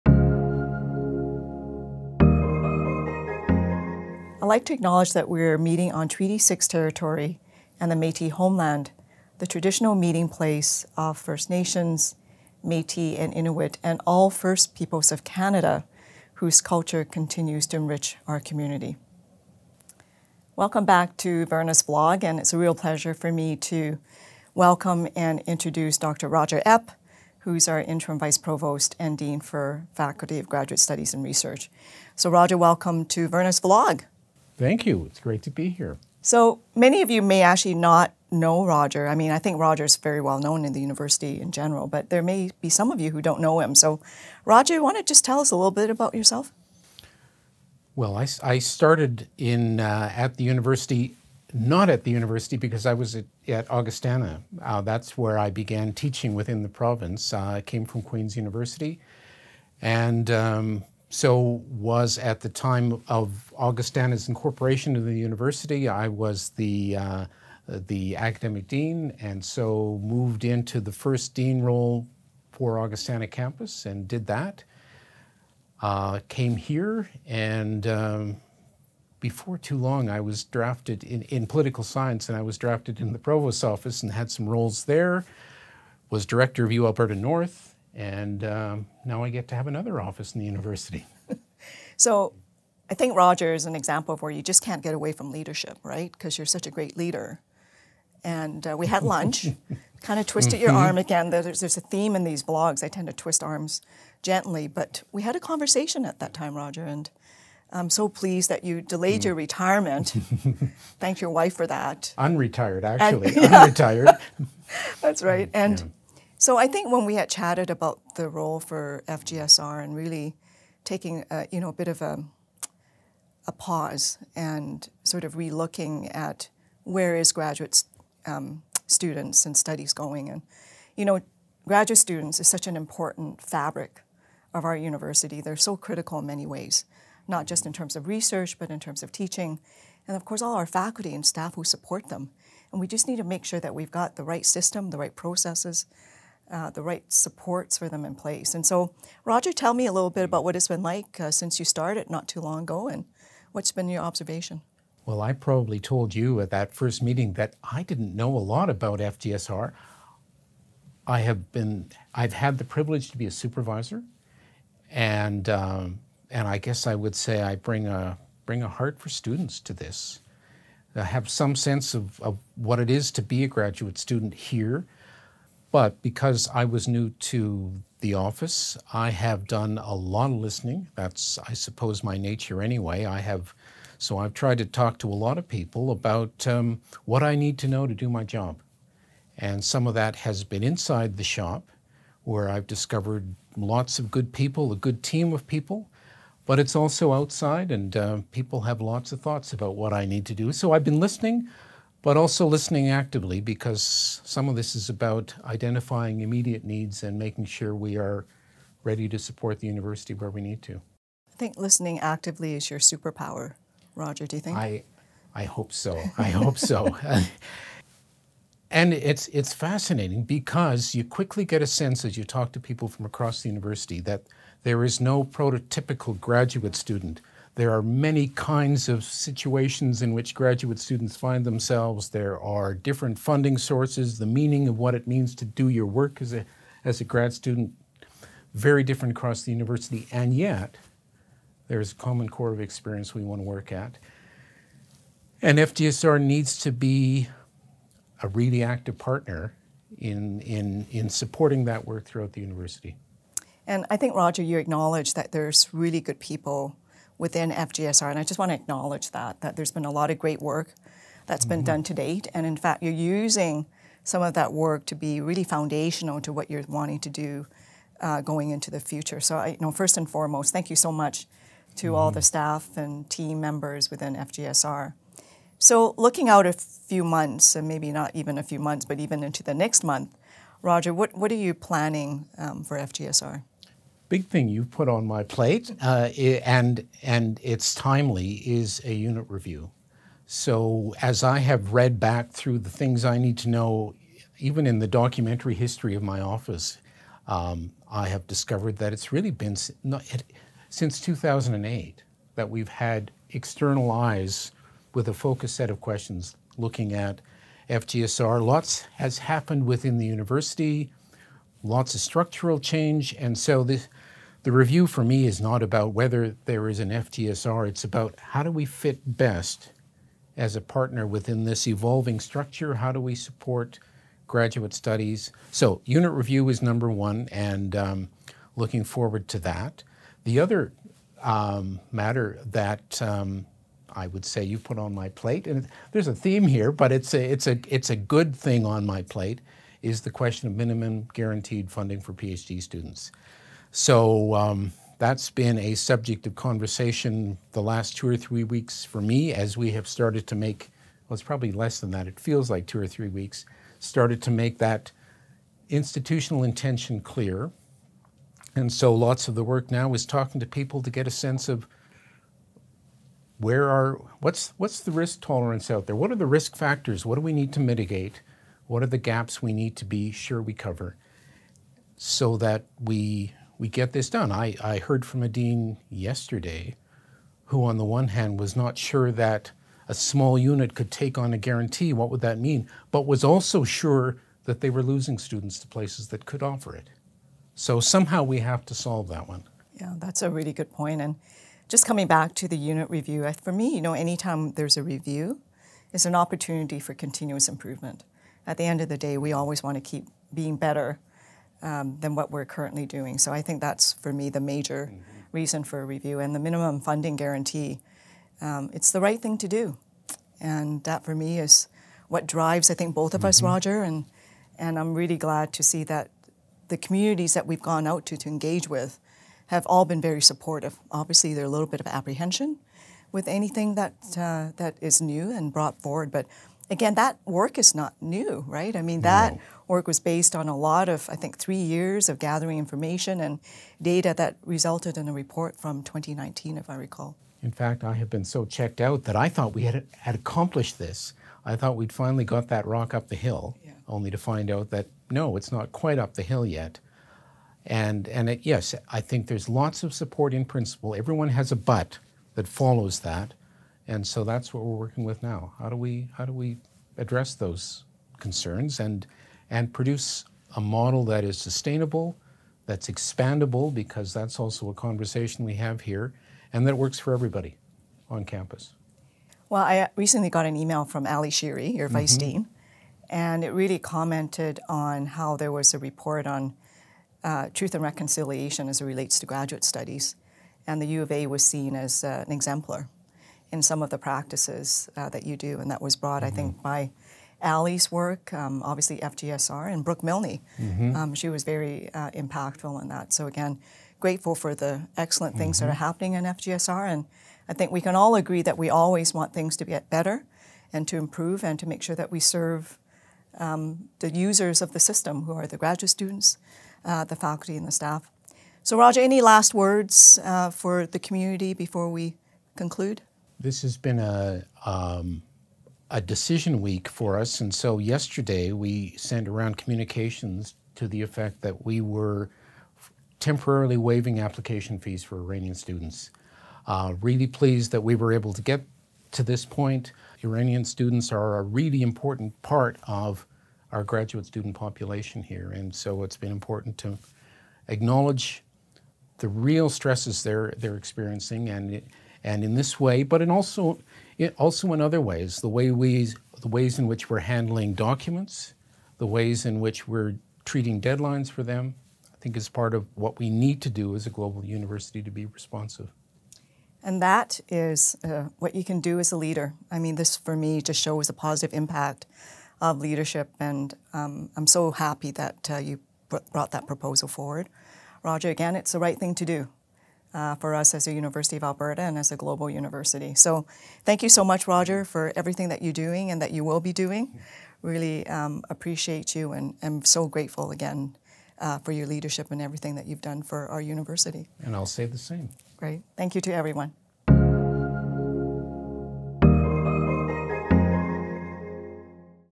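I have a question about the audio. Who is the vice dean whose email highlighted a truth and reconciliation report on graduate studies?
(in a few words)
Ali Shiri.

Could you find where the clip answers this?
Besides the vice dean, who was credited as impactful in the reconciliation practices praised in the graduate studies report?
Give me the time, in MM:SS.
08:09.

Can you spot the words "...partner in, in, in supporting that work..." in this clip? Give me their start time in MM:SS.
04:08.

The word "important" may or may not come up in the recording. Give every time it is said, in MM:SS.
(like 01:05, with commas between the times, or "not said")
02:12, 08:51, 08:56.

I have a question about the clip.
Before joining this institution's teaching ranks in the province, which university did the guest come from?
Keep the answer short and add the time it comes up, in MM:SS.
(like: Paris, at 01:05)
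Queen's University, at 00:58.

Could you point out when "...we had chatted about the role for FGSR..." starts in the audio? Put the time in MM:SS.
01:57.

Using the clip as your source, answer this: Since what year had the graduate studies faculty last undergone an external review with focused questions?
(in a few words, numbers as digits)
2008.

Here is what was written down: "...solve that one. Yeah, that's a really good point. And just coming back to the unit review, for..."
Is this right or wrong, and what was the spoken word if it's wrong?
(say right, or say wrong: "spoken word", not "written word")
right.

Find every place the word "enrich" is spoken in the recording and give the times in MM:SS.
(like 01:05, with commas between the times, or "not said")
00:17.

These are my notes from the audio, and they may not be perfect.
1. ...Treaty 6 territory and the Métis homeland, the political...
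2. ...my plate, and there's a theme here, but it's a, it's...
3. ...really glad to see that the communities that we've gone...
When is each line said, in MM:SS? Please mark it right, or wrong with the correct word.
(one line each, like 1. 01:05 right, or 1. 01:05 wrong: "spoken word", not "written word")
1. 00:06 wrong: "traditional", not "political"
2. 05:34 right
3. 06:54 right.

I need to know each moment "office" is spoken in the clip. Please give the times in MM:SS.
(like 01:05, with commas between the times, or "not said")
01:23, 01:29, 02:58, 04:56.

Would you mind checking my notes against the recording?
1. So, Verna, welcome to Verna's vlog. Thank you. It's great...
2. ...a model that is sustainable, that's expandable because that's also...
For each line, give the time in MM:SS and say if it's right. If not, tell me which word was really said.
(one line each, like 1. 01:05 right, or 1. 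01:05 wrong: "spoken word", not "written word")
1. 00:32 wrong: "Roger", not "Verna"
2. 07:40 right.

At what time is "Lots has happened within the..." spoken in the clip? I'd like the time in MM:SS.
05:08.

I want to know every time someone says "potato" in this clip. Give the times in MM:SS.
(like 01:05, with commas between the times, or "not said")
not said.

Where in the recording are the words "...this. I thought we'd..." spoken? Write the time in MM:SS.
07:20.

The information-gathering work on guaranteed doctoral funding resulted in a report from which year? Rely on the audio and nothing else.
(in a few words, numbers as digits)
2019.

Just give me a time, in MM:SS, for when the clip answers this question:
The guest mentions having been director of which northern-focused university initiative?
01:26.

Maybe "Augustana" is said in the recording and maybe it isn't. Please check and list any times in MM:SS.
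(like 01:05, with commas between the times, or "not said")
00:53, 01:03, 01:12.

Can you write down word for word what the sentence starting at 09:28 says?
Roger, again, it's the right thing to do uh, for us as a University of Alberta and as a global university.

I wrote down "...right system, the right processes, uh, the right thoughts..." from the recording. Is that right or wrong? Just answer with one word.
wrong.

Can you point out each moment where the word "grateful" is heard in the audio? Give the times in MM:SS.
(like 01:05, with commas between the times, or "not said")
08:13, 09:40.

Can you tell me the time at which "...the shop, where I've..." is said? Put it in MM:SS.
03:11.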